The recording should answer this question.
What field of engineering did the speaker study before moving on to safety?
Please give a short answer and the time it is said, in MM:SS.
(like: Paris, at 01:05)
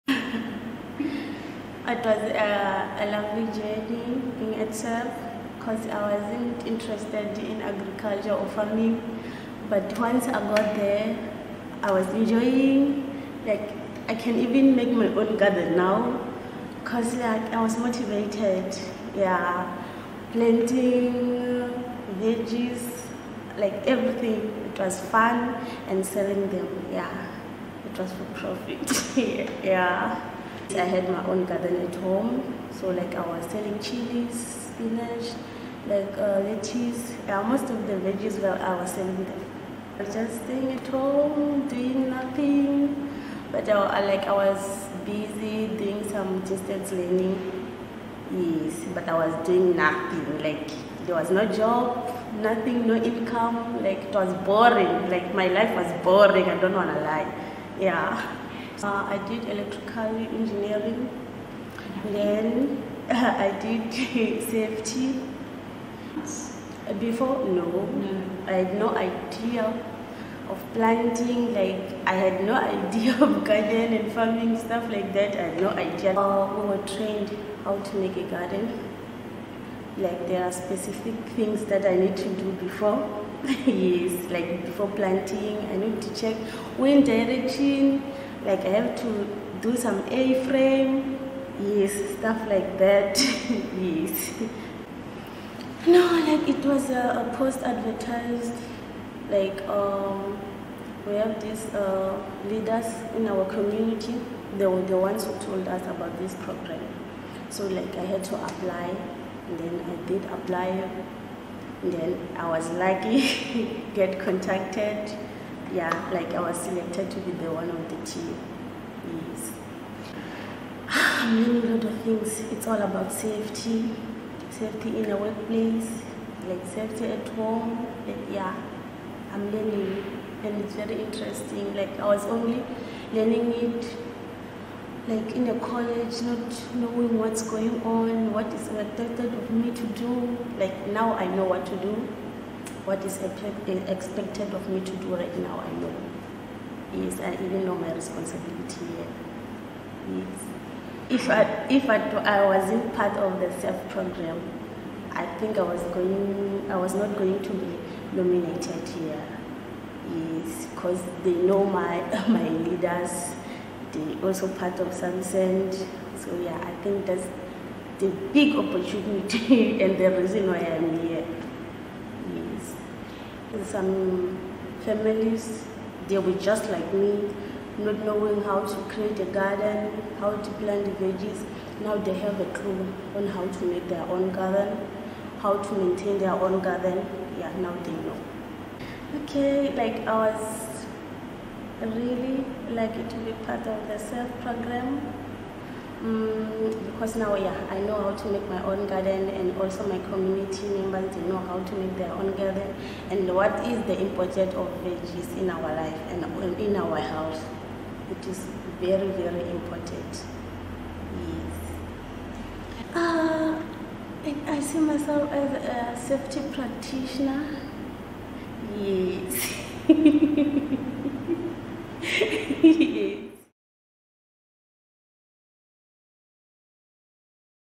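electrical engineering, at 00:59.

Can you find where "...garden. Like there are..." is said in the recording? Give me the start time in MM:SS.
01:18.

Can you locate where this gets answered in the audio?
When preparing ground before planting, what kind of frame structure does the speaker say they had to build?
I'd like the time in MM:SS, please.
01:30.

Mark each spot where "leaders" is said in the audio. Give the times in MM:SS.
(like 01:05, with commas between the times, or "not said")
01:42, 02:42.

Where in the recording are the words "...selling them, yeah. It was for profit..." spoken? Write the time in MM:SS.
00:26.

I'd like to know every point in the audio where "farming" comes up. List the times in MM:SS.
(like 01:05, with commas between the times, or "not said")
00:08, 01:14.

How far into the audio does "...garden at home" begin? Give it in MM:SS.
00:31.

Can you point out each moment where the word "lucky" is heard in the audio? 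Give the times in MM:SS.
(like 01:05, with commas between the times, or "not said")
01:52, 03:12.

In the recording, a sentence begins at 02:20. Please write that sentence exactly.
Like now I know what to do what is expected of me to do right now, I know.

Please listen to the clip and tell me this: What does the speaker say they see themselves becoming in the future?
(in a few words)
safety practitioner.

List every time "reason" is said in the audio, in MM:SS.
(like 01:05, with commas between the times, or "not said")
02:50.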